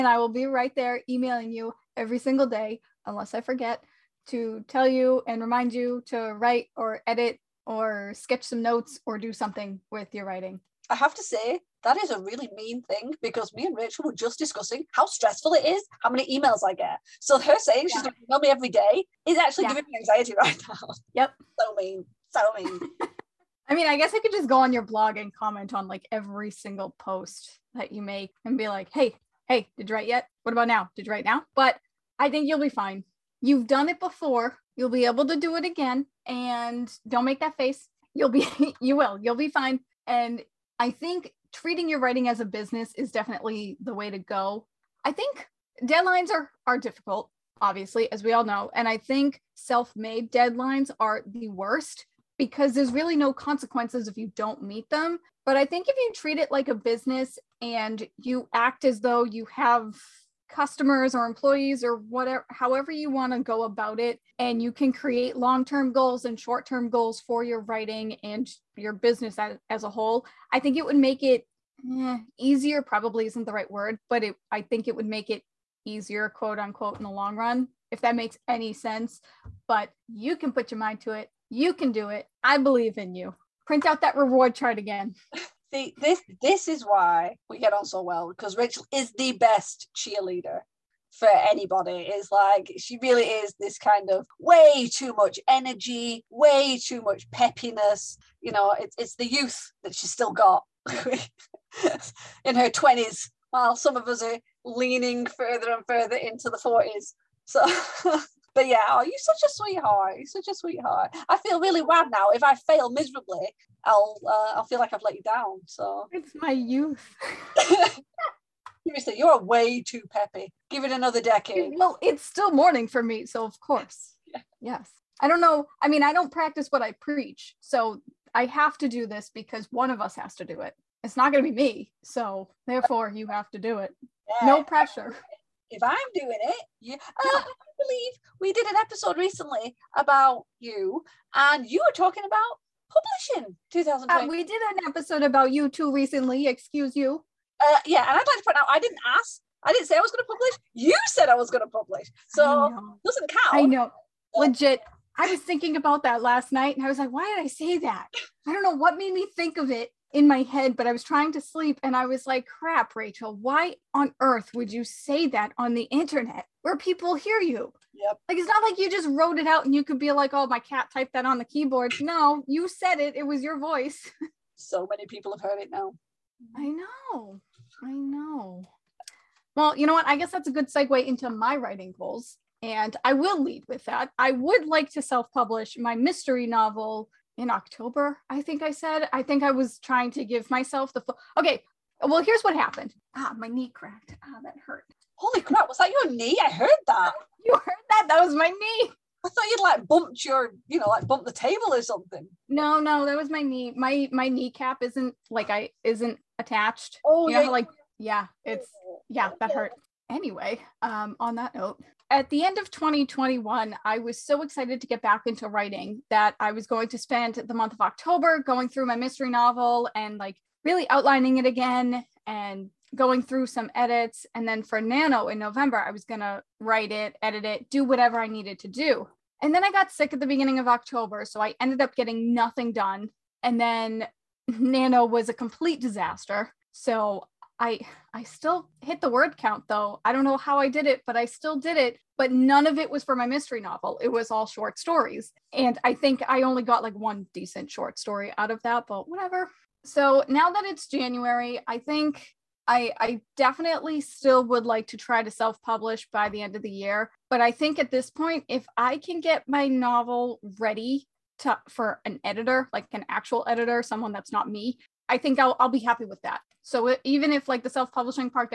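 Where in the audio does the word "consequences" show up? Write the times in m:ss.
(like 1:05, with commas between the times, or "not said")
0:53.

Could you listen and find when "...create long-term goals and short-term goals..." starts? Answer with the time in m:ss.
1:04.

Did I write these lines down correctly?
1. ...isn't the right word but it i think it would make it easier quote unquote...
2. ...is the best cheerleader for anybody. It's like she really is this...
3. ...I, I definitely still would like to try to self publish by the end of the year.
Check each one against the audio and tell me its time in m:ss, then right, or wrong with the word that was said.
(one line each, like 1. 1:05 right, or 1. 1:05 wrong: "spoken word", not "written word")
1. 1:13 right
2. 1:28 right
3. 4:12 right.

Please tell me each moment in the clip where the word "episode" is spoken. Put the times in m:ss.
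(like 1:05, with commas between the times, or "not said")
2:18, 2:24.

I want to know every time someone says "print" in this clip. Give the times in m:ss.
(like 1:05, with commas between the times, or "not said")
1:23.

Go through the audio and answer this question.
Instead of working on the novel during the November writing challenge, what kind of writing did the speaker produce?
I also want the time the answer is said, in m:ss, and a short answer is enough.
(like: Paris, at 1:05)
Short stories, at 4:04.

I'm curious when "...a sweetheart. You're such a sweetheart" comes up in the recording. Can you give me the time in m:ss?
1:49.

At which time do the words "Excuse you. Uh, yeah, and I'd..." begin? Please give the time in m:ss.
2:26.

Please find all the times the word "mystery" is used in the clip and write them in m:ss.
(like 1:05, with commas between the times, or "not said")
3:05, 3:38, 4:03.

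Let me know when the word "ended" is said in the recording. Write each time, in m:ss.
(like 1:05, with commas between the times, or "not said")
3:51.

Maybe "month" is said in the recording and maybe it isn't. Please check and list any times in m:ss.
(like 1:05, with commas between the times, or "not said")
3:37.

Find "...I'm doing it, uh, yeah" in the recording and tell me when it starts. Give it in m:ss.
2:15.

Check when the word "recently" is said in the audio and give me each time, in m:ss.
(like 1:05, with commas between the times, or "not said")
2:19, 2:25.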